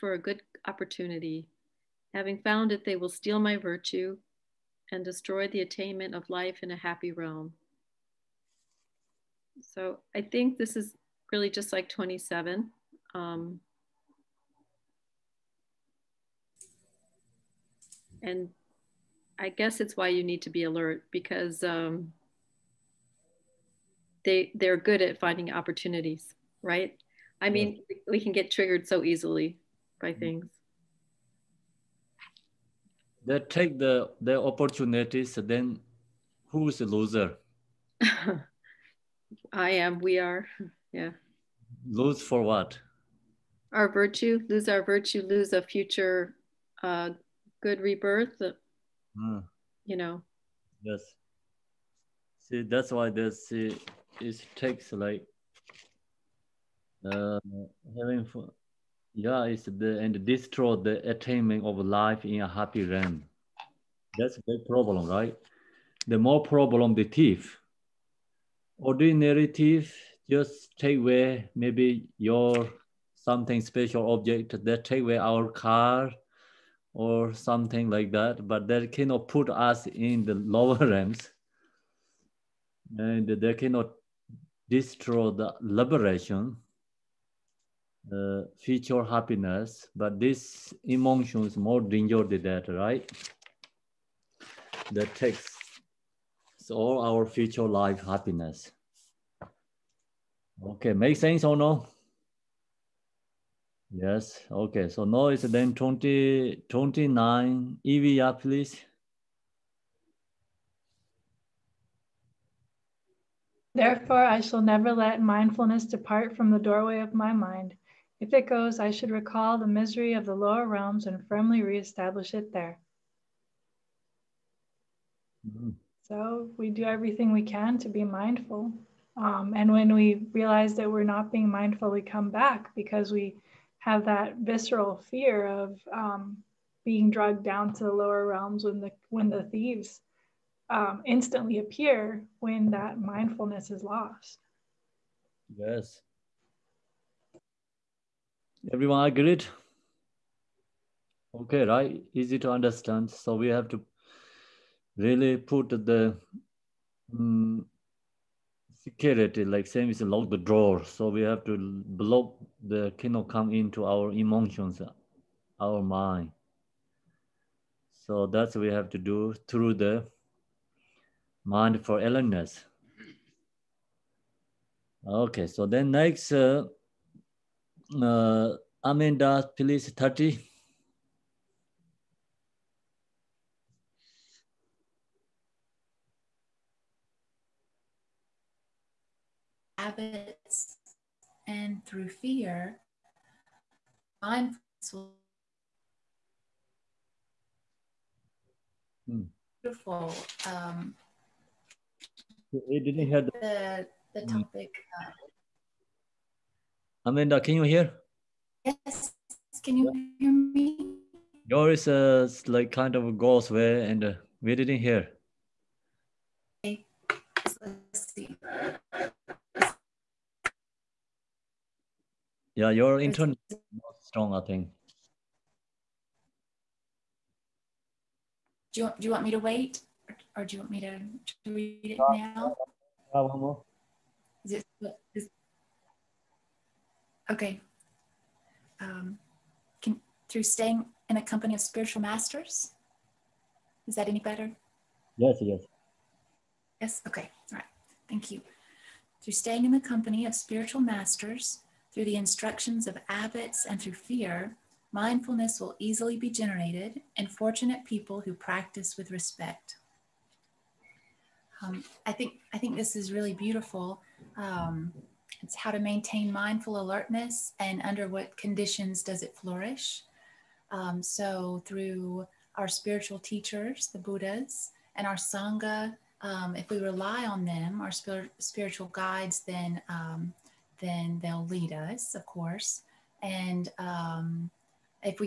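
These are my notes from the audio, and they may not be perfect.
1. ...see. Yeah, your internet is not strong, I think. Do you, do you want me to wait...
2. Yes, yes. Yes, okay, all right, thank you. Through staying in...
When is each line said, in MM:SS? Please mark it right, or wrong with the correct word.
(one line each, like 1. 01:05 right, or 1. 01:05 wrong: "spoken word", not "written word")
1. 03:38 right
2. 04:05 right.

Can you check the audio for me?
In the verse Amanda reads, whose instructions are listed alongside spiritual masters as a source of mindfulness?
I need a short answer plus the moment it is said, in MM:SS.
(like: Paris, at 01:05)
abbots, at 04:13.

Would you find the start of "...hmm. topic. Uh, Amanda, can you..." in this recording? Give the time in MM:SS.
03:24.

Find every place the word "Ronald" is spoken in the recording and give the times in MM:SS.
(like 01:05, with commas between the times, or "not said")
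not said.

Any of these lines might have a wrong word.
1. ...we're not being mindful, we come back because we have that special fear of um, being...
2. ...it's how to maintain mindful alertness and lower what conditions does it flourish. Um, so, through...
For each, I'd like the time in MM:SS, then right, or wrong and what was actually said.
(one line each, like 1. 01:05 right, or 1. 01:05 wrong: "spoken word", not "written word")
1. 02:10 wrong: "visceral", not "special"
2. 04:25 wrong: "under", not "lower".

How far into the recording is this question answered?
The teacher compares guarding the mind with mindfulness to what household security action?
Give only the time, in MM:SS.
02:40.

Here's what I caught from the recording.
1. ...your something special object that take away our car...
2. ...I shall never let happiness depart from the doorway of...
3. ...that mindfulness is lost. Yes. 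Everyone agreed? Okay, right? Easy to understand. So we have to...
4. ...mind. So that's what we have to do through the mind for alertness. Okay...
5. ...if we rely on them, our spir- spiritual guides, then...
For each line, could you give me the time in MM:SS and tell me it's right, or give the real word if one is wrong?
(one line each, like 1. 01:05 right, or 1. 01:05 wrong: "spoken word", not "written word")
1. 01:12 right
2. 01:54 wrong: "mindfulness", not "happiness"
3. 02:22 right
4. 02:45 wrong: "illness", not "alertness"
5. 04:36 right.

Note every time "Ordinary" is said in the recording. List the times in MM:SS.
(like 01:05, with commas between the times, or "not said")
01:08.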